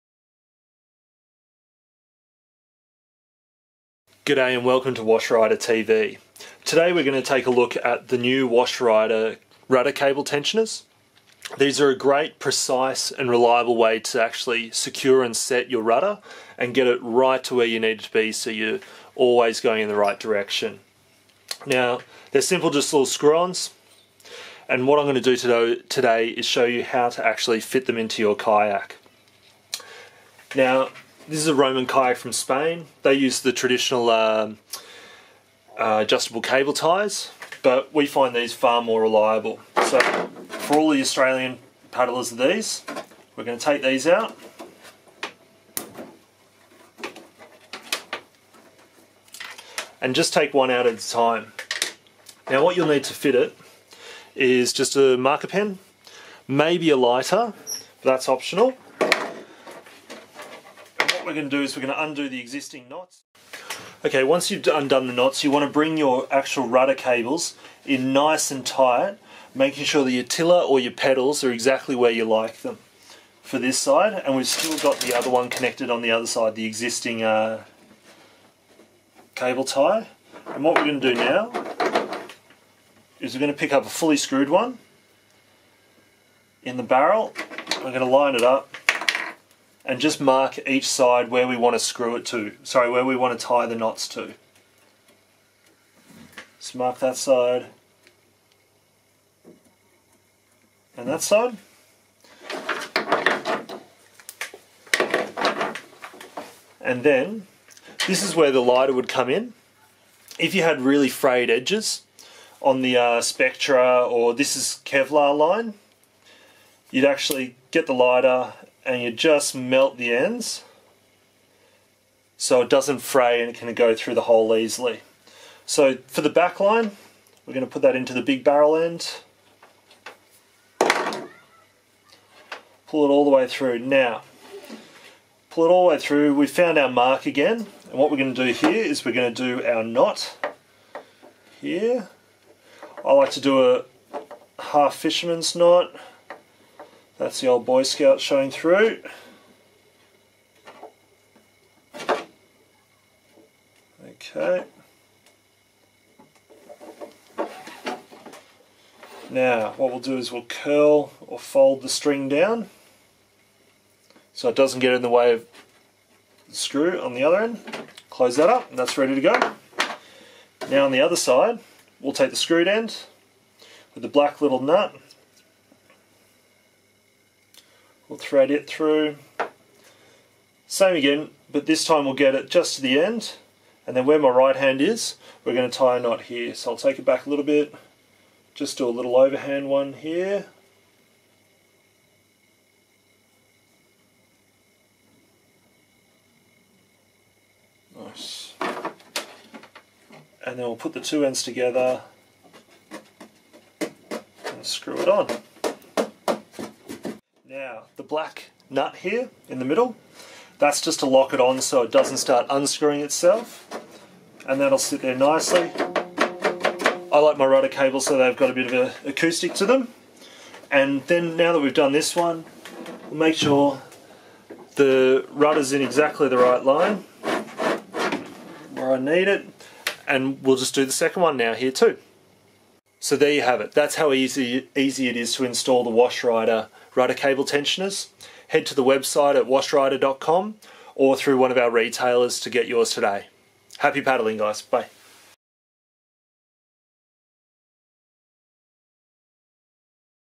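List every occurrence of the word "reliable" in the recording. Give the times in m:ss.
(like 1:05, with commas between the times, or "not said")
0:13, 0:39.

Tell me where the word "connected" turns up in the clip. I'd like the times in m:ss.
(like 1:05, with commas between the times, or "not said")
1:15.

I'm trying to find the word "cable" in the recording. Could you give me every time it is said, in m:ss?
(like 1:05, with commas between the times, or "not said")
0:09, 0:36, 1:06, 1:19, 3:37, 3:57.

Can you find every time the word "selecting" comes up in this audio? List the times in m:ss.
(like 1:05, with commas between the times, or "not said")
not said.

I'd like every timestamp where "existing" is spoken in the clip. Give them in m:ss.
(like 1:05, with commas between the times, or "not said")
1:02, 1:16.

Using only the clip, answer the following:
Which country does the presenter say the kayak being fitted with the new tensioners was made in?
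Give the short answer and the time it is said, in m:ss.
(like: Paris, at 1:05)
Spain, at 0:32.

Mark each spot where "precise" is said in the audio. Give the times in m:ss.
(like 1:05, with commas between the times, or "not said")
0:12.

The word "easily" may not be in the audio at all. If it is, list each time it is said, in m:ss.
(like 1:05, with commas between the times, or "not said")
2:04.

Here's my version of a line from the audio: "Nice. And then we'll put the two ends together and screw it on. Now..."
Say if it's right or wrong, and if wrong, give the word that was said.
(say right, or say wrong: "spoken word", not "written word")
right.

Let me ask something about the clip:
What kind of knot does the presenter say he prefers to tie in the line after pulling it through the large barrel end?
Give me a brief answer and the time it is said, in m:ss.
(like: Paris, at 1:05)
Half fisherman's knot, at 2:24.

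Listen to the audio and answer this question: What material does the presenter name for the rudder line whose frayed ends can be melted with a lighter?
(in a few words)
Kevlar.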